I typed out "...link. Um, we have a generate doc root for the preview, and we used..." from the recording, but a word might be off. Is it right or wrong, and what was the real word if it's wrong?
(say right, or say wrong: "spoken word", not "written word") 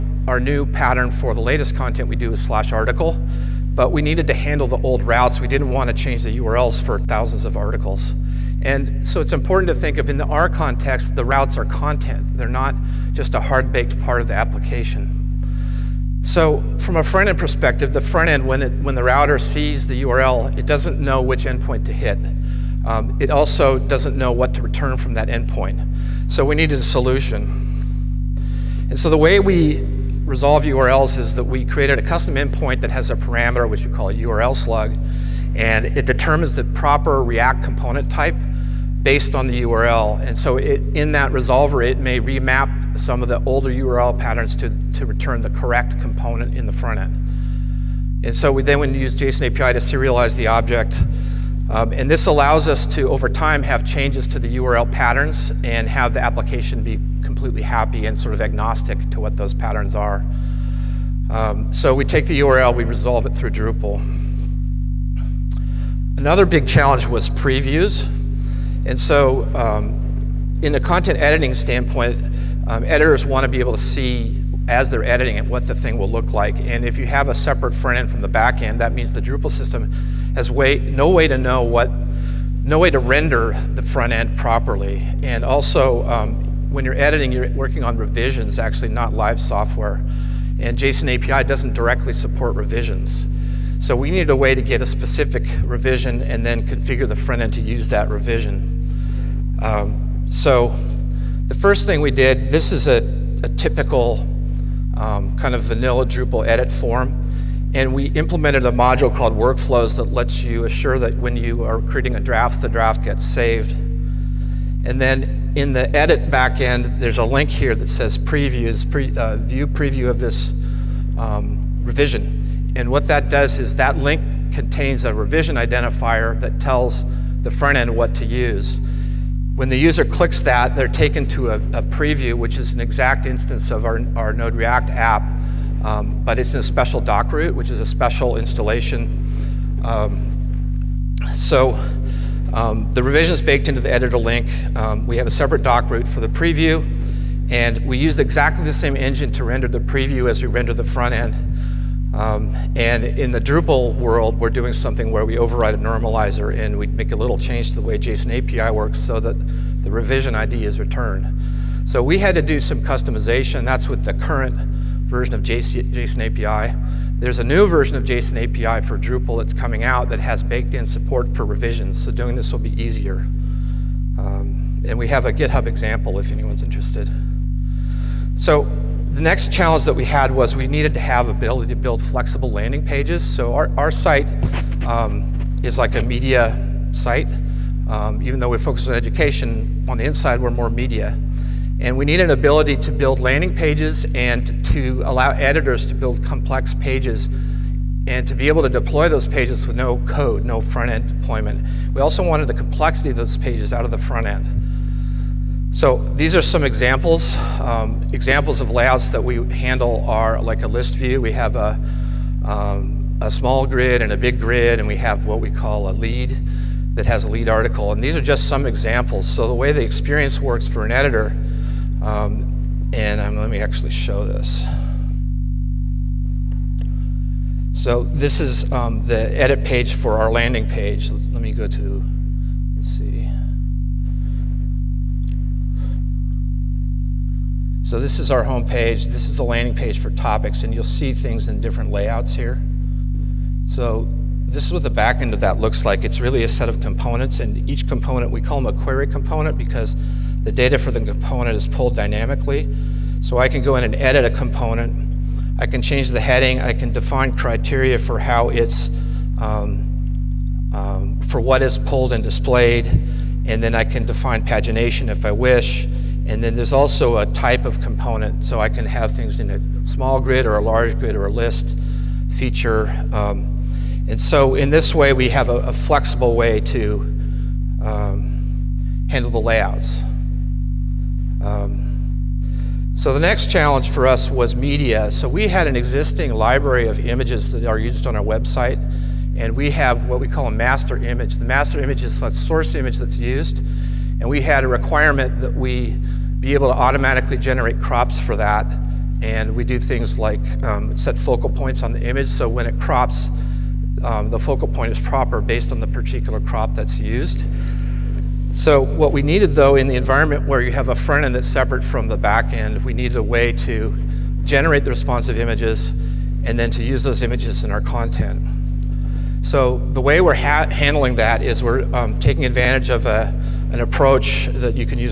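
wrong: "separate", not "generate".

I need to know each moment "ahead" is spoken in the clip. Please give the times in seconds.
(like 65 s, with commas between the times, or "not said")
not said.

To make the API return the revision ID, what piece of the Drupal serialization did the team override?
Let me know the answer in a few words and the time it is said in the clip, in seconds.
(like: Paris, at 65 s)
a normalizer, at 155 s.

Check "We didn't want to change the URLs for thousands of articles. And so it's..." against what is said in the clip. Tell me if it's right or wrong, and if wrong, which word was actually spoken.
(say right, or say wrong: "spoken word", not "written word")
right.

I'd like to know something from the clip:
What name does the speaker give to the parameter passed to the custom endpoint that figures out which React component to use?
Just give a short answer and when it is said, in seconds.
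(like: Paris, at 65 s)
URL slug, at 34 s.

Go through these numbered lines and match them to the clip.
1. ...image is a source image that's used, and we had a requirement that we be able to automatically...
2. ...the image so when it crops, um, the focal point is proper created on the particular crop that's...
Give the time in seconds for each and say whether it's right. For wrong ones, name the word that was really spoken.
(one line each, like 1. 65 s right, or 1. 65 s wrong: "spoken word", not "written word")
1. 291 s right
2. 301 s wrong: "based", not "created".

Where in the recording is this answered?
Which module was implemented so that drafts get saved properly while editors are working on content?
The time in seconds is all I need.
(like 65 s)
109 s.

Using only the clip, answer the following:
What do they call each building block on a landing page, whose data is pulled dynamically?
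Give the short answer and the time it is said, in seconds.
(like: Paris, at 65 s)
query component, at 248 s.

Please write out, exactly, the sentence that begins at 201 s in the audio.
We also wanted the complexity of those pages out of the front end.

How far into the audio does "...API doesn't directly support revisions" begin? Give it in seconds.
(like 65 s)
91 s.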